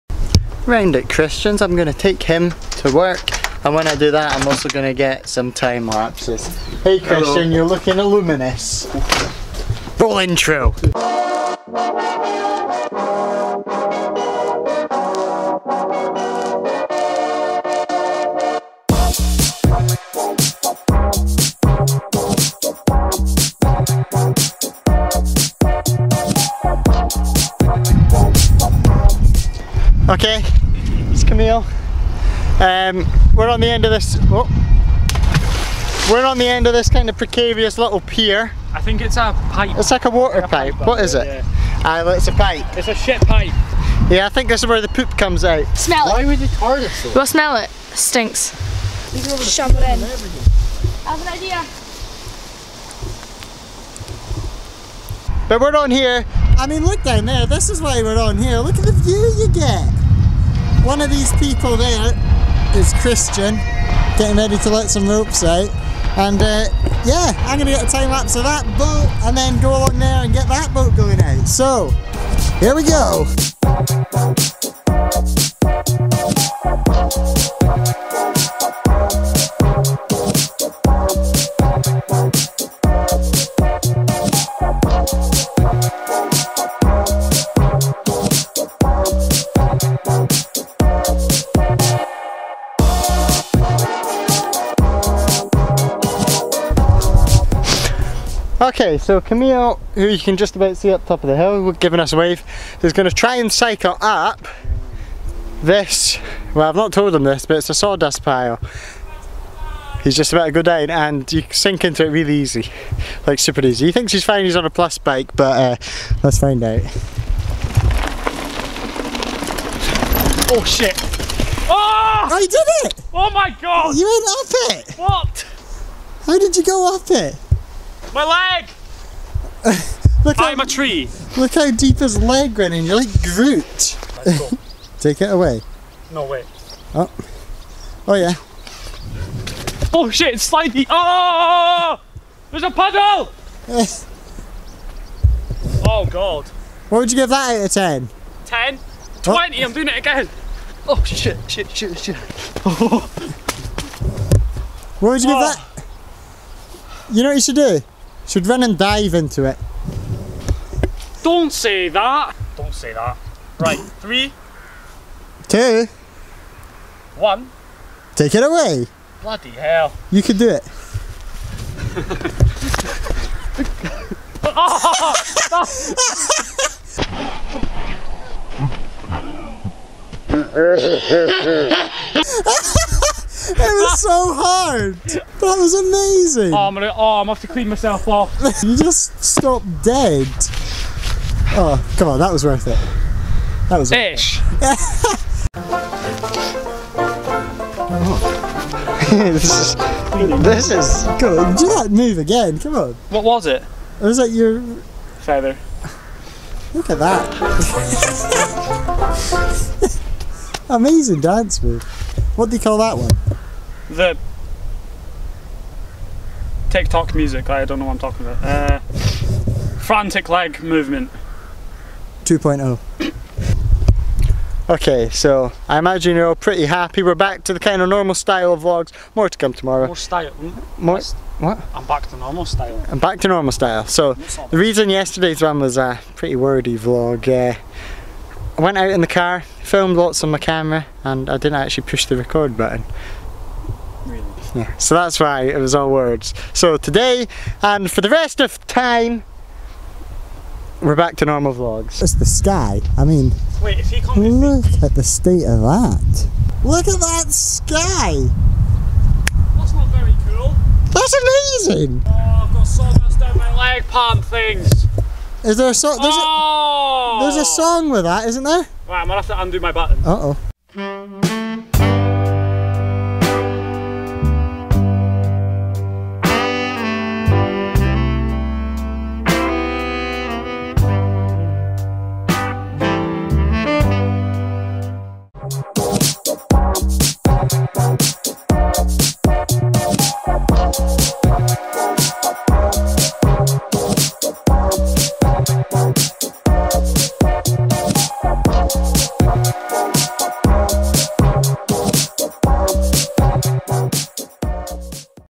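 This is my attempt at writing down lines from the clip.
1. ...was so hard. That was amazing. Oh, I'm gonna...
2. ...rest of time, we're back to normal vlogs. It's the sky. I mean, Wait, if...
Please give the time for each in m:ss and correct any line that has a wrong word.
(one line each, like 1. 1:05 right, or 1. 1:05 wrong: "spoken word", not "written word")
1. 3:03 right
2. 4:08 right.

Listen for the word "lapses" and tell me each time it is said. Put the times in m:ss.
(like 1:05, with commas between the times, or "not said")
0:05, 1:08.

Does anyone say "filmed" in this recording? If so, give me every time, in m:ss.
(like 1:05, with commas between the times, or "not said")
3:59.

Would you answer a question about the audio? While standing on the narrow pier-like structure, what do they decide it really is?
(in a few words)
A shit pipe.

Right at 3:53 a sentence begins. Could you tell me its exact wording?
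So the reason yesterday's one was a pretty wordy vlog.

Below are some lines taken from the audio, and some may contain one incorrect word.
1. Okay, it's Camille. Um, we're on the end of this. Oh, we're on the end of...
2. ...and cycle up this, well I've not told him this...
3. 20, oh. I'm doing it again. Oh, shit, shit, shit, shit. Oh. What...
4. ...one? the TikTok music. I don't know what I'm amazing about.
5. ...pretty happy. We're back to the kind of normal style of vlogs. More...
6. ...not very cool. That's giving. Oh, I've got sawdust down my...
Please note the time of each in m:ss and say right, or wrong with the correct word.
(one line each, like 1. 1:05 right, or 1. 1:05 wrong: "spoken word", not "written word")
1. 0:30 right
2. 1:43 right
3. 2:29 right
4. 3:32 wrong: "talking", not "amazing"
5. 3:46 right
6. 4:19 wrong: "amazing", not "giving".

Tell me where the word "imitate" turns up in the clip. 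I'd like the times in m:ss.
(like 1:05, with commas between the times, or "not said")
not said.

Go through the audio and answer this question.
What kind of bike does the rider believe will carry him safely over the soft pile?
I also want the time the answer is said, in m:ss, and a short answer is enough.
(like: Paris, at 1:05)
A plus bike, at 1:54.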